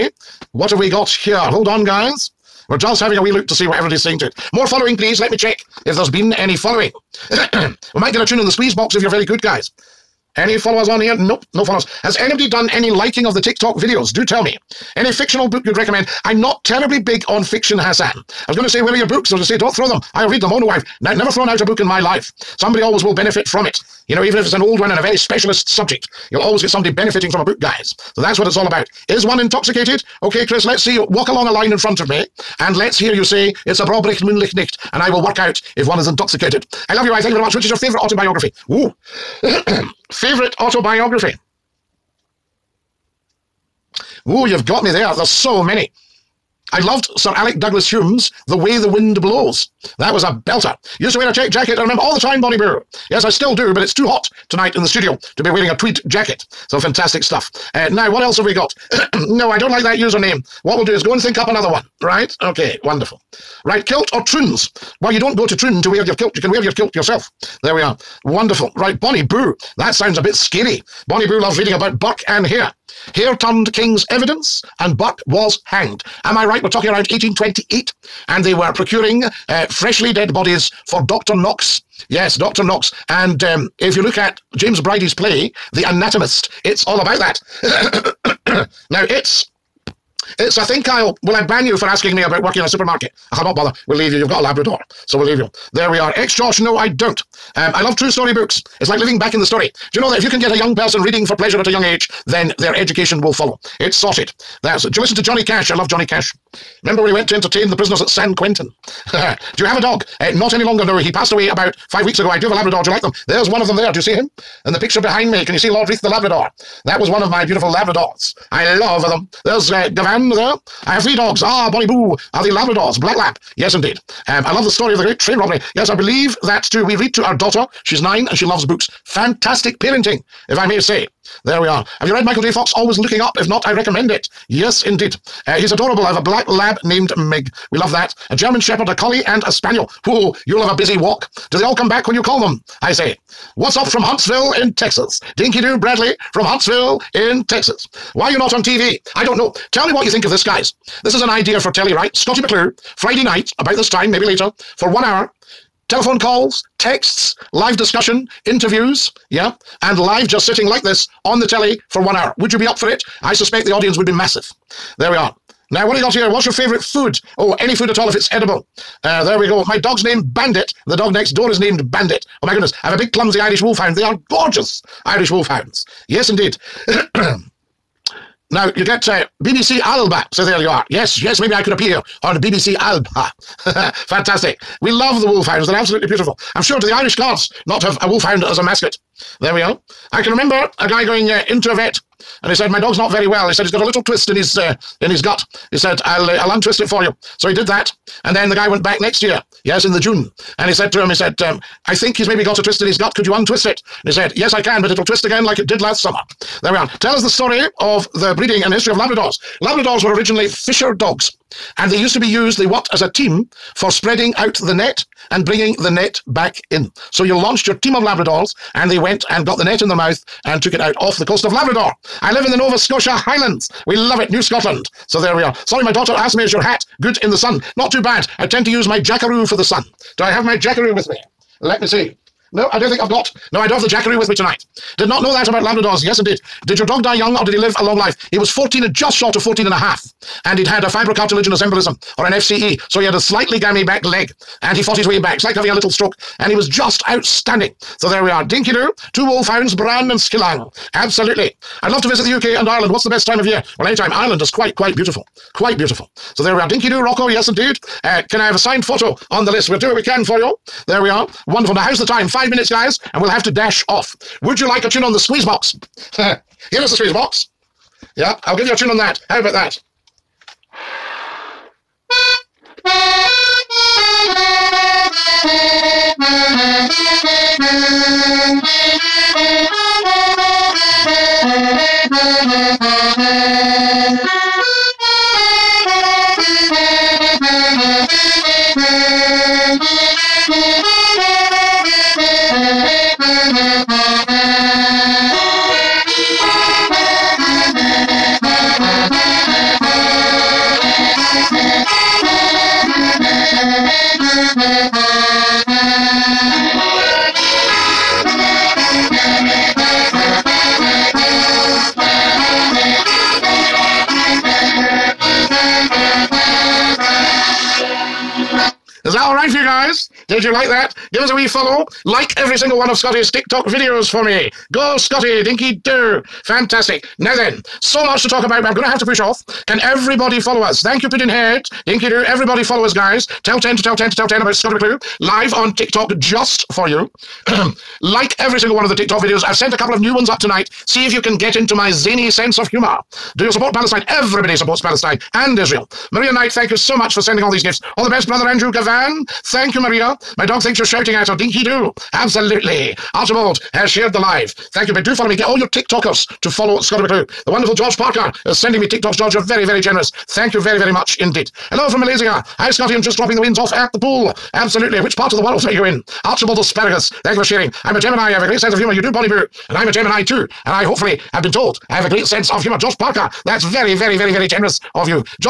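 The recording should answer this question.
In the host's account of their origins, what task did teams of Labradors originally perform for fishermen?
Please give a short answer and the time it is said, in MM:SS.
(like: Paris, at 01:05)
spreading out the net, at 03:33.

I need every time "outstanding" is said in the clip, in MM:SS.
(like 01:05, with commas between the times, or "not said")
04:07.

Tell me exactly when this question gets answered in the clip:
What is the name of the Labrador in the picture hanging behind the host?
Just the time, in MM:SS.
01:55.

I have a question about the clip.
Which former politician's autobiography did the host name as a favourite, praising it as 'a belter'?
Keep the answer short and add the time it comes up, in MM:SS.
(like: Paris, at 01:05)
Sir Alec Douglas-Home, at 00:47.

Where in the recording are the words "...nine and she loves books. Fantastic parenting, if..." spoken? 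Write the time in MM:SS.
02:08.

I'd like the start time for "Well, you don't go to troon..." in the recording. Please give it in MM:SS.
01:05.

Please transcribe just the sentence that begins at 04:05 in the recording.
It's like having a little stroke.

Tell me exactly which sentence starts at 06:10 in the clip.
And I hopefully have been told I have a great sense of humor.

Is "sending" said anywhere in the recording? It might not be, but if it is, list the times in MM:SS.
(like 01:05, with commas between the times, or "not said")
05:47, 05:58.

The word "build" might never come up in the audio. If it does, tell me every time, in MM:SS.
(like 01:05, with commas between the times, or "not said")
not said.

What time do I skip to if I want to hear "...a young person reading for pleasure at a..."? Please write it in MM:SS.
01:40.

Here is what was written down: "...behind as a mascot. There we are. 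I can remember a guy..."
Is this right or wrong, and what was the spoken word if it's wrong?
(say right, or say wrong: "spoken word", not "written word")
wrong: "wolfhound", not "behind".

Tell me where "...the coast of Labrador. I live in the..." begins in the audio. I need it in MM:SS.
03:41.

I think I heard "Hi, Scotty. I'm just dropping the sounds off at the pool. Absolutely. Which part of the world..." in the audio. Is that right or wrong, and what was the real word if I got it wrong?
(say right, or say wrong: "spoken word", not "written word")
wrong: "winds", not "sounds".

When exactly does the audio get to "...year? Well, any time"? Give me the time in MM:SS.
04:13.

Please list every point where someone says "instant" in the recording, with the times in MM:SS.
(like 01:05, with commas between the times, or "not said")
not said.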